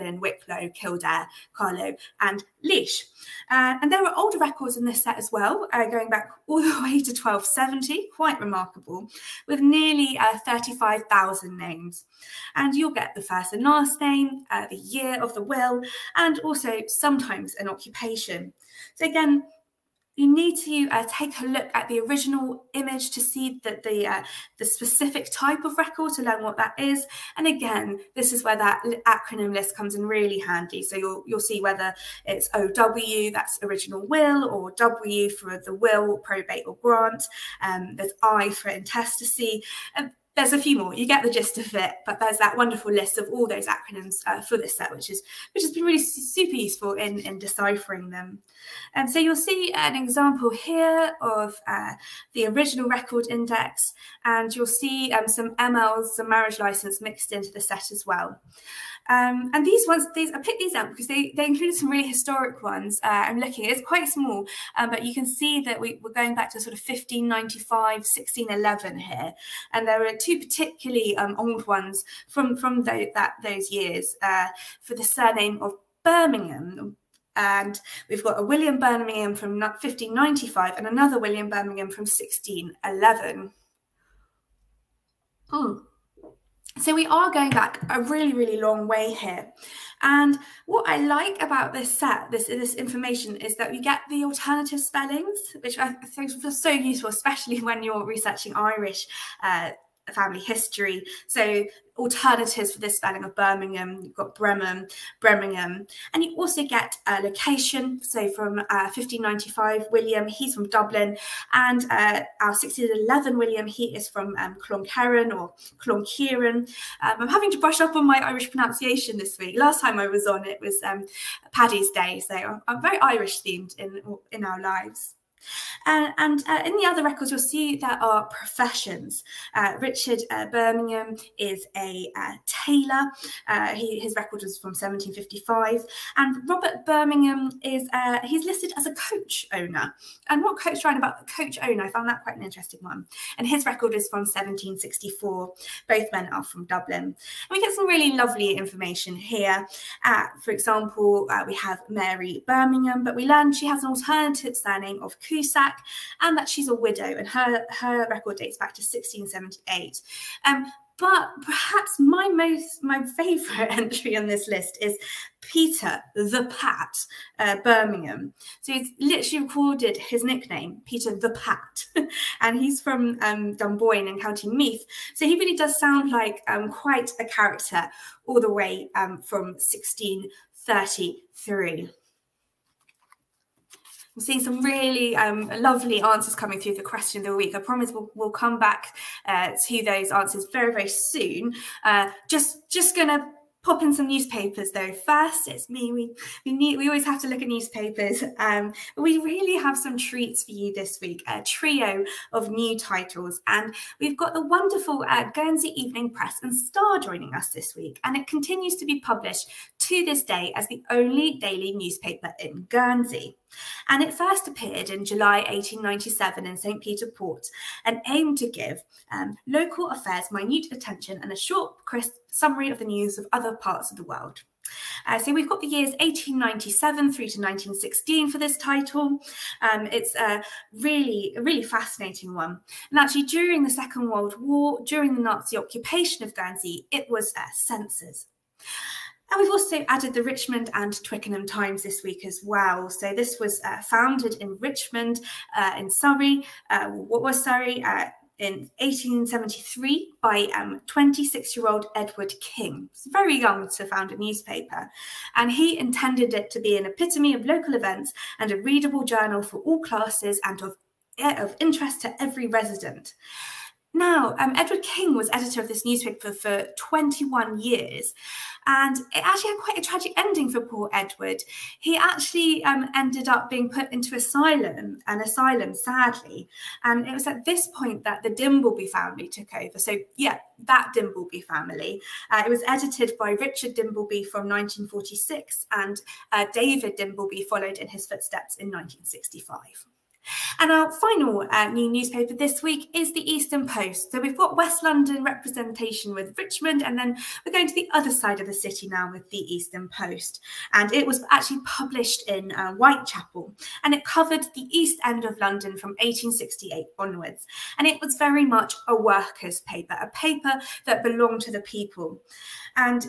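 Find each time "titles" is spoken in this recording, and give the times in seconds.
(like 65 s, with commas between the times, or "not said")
202 s, 228 s.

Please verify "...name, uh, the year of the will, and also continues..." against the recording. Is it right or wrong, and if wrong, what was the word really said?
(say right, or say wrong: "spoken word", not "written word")
wrong: "sometimes", not "continues".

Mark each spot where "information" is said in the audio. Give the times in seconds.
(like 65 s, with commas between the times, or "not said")
92 s, 148 s.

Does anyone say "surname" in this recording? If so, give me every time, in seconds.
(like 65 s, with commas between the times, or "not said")
75 s, 154 s.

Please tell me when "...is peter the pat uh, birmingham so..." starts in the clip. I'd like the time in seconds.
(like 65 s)
164 s.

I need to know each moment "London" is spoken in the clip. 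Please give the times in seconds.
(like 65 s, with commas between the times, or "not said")
294 s, 305 s.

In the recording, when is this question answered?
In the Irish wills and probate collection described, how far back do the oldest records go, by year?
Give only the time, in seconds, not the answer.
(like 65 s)
7 s.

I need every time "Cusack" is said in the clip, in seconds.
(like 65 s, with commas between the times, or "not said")
155 s.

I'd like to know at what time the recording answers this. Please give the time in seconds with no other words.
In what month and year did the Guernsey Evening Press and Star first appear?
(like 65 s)
215 s.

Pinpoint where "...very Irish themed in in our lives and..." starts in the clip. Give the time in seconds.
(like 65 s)
122 s.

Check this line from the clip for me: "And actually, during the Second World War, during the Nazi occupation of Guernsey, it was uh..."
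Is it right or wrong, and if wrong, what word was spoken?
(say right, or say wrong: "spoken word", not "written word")
right.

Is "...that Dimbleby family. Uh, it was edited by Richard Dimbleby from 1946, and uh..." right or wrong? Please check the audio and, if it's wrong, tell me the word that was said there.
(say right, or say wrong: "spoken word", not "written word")
right.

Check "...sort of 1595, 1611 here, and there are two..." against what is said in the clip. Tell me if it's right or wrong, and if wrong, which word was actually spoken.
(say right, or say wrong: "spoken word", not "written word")
right.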